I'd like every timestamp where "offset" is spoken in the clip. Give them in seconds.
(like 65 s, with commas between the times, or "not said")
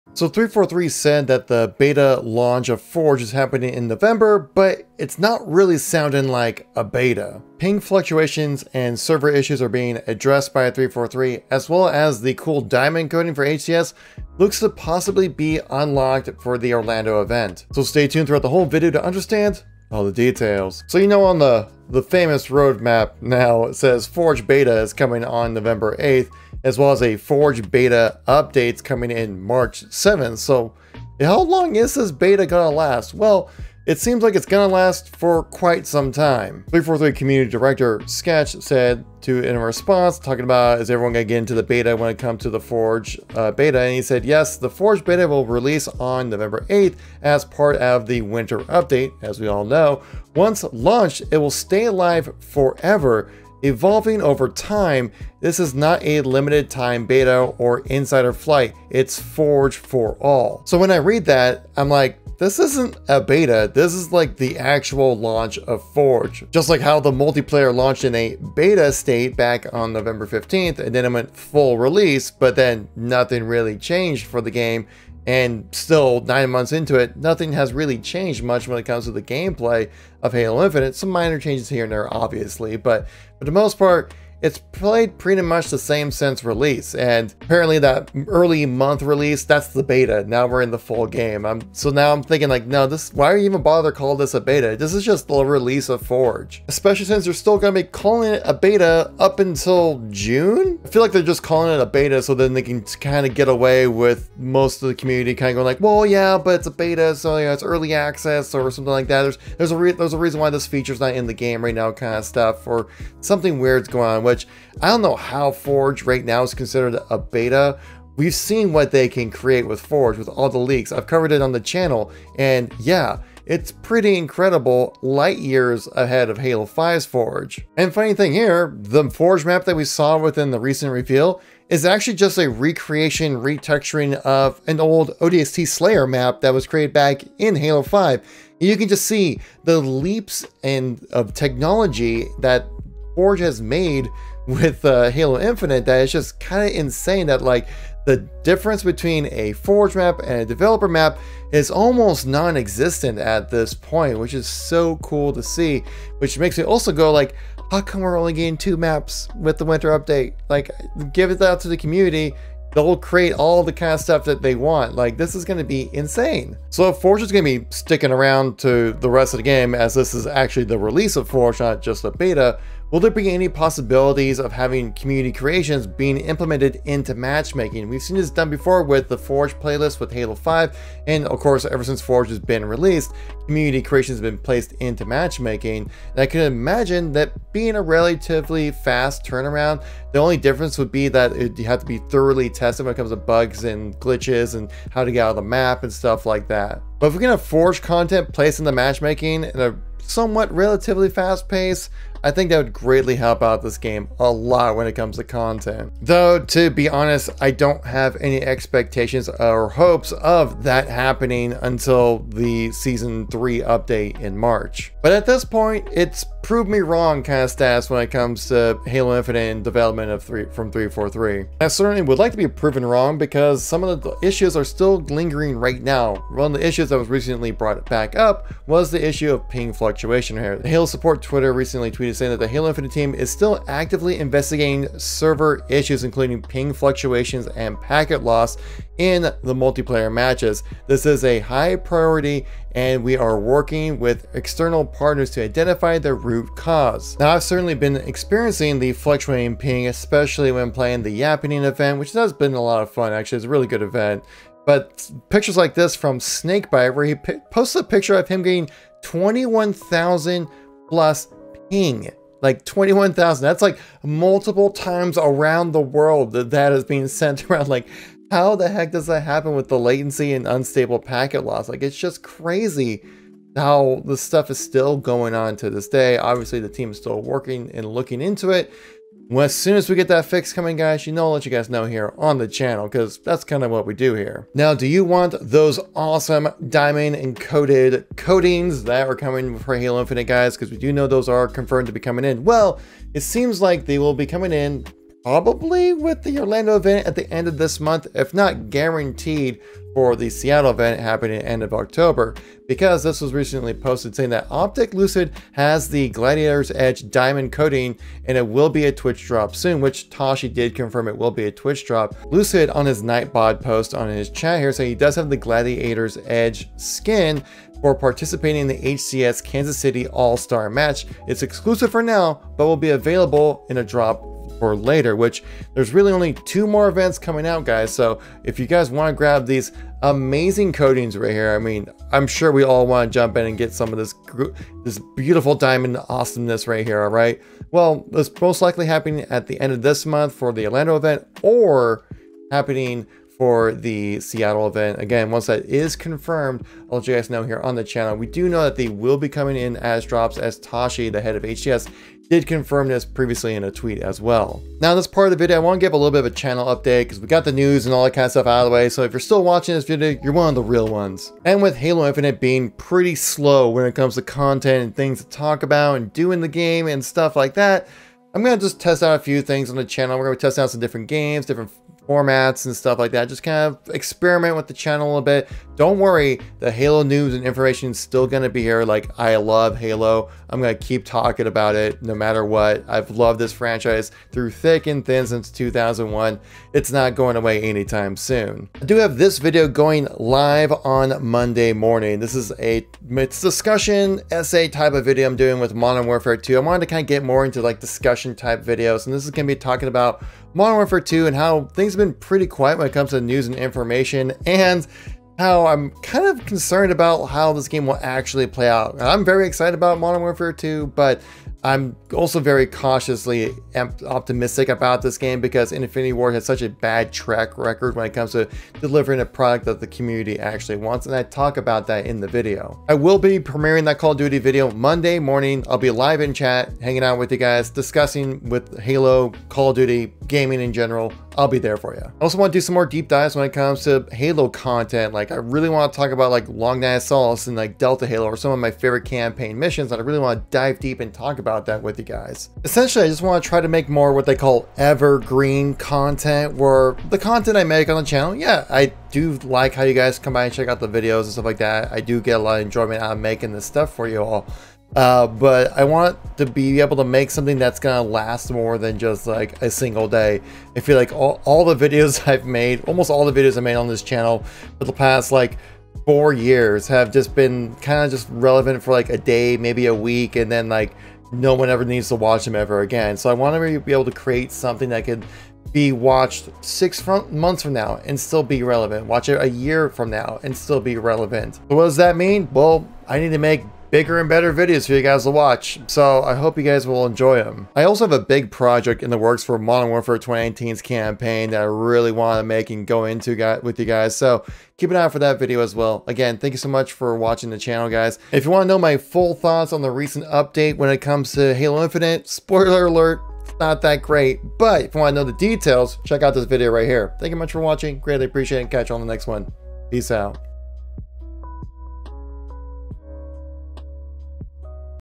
not said.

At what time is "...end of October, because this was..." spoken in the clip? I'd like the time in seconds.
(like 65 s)
301 s.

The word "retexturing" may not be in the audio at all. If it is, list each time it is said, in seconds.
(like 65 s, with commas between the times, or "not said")
133 s.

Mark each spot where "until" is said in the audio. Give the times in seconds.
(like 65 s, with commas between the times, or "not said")
99 s, 211 s.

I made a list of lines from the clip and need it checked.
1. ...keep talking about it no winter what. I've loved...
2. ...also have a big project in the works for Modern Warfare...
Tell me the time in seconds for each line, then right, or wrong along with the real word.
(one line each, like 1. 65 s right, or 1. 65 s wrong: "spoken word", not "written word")
1. 380 s wrong: "matter", not "winter"
2. 487 s right.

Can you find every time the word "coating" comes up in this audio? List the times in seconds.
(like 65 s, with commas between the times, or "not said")
13 s, 288 s, 307 s, 330 s.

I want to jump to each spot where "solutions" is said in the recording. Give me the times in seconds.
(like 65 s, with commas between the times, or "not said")
not said.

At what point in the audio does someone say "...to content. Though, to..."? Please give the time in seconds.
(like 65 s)
205 s.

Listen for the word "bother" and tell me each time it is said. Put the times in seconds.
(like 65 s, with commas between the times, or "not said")
93 s.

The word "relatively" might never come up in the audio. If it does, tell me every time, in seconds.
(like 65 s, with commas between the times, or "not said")
187 s, 200 s.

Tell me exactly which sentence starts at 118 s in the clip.
We've seen what they can create with Forge with all the leaks.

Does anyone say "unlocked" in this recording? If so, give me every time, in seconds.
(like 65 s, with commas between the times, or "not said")
15 s.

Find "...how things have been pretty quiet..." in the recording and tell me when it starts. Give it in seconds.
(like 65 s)
401 s.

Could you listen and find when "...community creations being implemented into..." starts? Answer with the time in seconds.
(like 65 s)
174 s.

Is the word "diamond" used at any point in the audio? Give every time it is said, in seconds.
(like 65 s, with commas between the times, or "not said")
12 s, 286 s, 307 s, 335 s.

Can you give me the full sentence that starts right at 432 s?
I also want to do some more deep dives when it comes to Halo content.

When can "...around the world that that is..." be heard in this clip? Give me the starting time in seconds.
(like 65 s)
265 s.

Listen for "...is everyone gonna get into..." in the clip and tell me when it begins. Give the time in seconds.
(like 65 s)
40 s.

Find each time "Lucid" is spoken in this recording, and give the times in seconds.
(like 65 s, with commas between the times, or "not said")
304 s, 312 s.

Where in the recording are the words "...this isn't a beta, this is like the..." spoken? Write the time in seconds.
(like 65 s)
62 s.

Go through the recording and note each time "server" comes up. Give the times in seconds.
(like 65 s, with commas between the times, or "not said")
8 s, 234 s.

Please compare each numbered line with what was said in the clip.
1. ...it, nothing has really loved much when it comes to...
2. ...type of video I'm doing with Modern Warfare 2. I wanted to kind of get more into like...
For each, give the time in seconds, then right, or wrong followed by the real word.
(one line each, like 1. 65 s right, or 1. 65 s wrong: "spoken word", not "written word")
1. 76 s wrong: "changed", not "loved"
2. 394 s right.